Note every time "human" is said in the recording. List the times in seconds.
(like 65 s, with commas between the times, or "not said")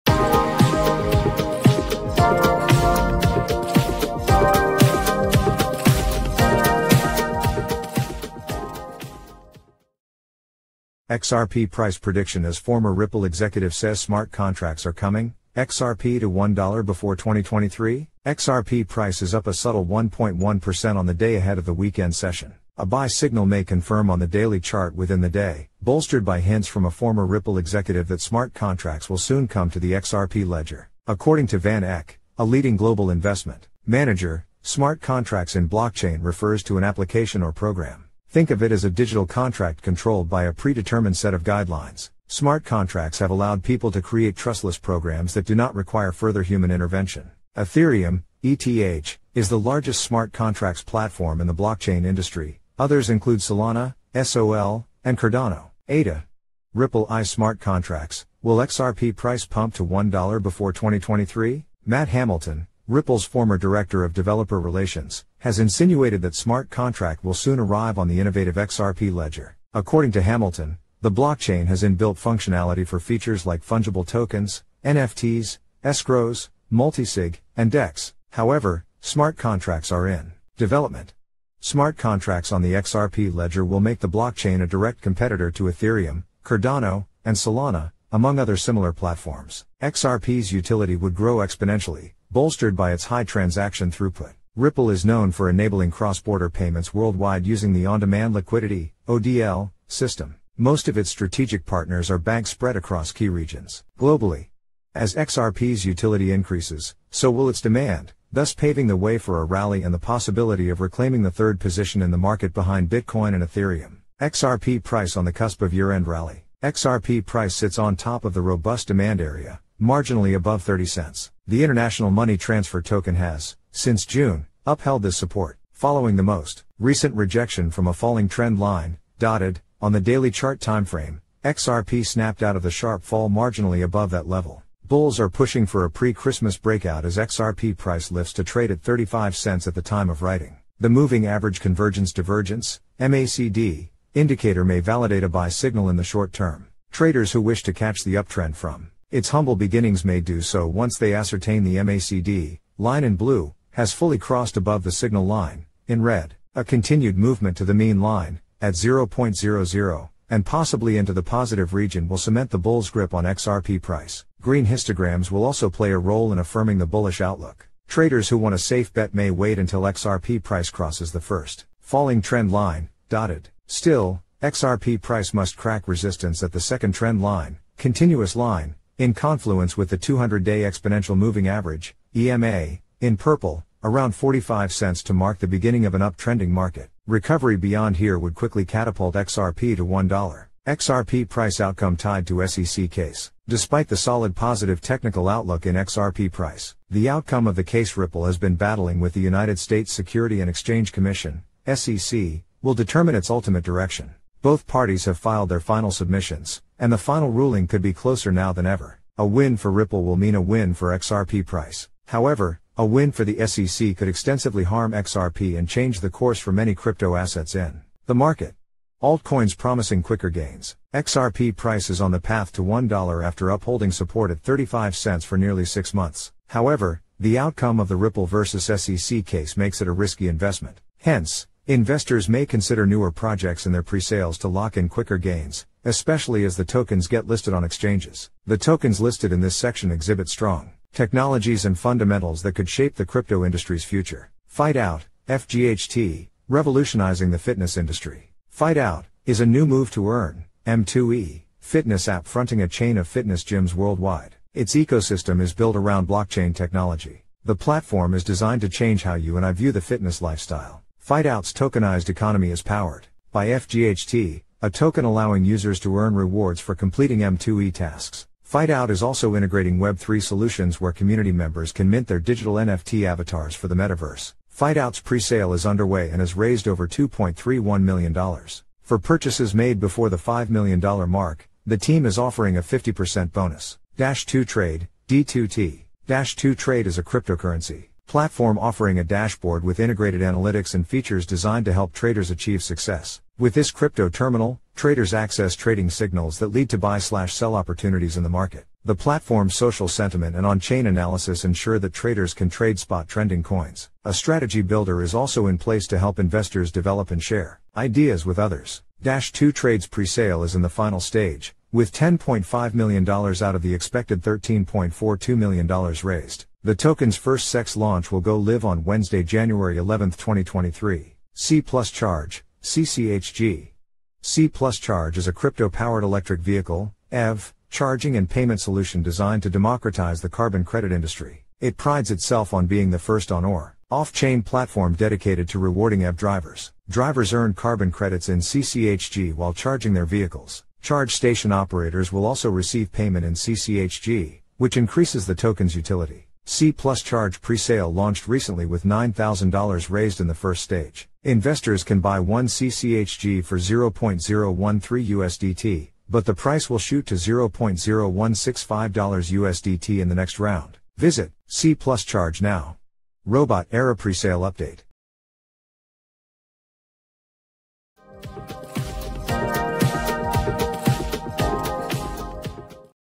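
46 s.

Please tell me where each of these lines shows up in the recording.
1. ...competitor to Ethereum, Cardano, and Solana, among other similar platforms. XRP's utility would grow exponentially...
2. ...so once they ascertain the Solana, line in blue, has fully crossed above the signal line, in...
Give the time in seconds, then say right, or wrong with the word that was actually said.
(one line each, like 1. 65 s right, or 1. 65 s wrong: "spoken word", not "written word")
1. 85 s right
2. 150 s wrong: "MACD", not "Solana".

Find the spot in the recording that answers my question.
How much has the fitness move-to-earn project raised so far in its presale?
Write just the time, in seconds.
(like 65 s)
276 s.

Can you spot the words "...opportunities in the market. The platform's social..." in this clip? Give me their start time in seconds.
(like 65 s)
297 s.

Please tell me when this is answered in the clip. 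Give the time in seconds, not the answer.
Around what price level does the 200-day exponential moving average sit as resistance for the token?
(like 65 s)
184 s.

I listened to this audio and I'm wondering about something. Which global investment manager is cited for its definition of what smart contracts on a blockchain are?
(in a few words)
VanEck.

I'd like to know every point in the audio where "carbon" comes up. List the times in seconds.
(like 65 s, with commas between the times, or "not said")
330 s, 337 s.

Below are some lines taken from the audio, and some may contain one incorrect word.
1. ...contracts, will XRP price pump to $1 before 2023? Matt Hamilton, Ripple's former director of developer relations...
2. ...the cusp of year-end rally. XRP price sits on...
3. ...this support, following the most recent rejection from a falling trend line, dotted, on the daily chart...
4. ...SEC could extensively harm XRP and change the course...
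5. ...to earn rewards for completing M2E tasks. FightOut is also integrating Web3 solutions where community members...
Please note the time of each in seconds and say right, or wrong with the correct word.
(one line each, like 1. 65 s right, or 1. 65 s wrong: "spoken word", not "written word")
1. 57 s right
2. 115 s right
3. 125 s right
4. 213 s right
5. 265 s right.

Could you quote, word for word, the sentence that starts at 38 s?
Think of it as a digital contract controlled by a predetermined set of guidelines.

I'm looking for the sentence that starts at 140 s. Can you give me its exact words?
The moving average convergence divergence, MACD, indicator may validate a buy signal in the short term.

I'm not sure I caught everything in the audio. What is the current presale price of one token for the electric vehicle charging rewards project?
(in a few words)
0.013 USDT.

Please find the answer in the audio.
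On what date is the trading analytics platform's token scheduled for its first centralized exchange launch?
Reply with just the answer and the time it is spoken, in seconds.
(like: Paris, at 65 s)
January 11, 2023, at 319 s.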